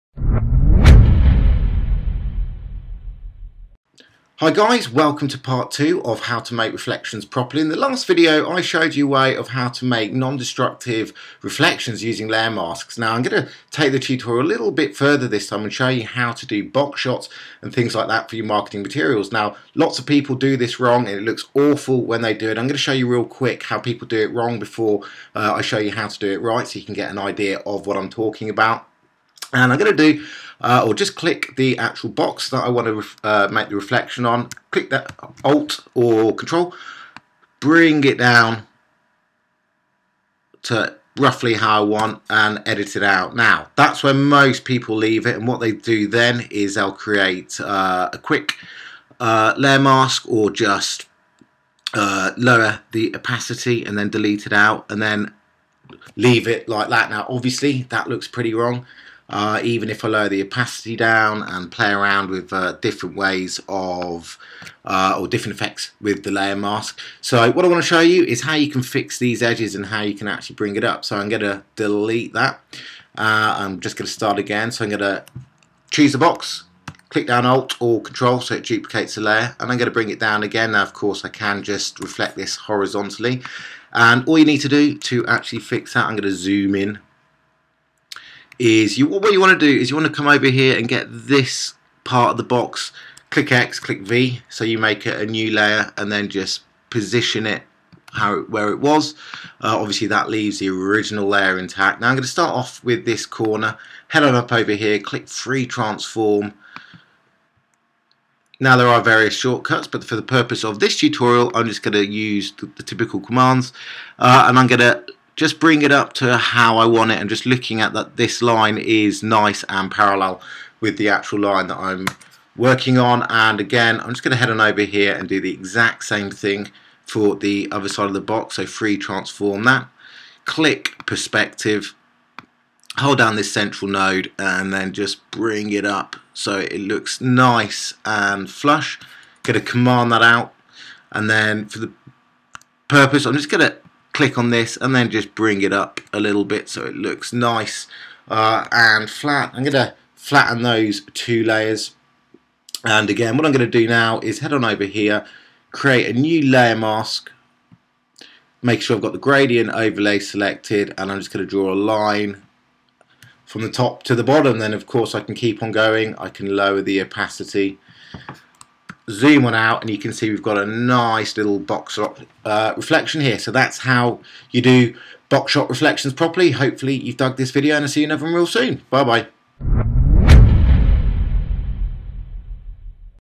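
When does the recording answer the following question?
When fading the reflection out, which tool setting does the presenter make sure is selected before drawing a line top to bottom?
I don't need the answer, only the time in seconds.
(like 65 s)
159 s.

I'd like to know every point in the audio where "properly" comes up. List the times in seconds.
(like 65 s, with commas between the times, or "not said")
7 s, 176 s.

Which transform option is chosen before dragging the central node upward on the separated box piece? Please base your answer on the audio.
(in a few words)
Perspective.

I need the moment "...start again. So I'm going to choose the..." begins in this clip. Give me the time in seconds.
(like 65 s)
74 s.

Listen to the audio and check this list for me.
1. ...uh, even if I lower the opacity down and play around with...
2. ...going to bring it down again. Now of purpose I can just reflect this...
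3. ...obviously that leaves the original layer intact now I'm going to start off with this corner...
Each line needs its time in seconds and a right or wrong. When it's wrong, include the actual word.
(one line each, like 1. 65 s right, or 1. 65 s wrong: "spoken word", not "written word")
1. 59 s right
2. 79 s wrong: "course", not "purpose"
3. 99 s right.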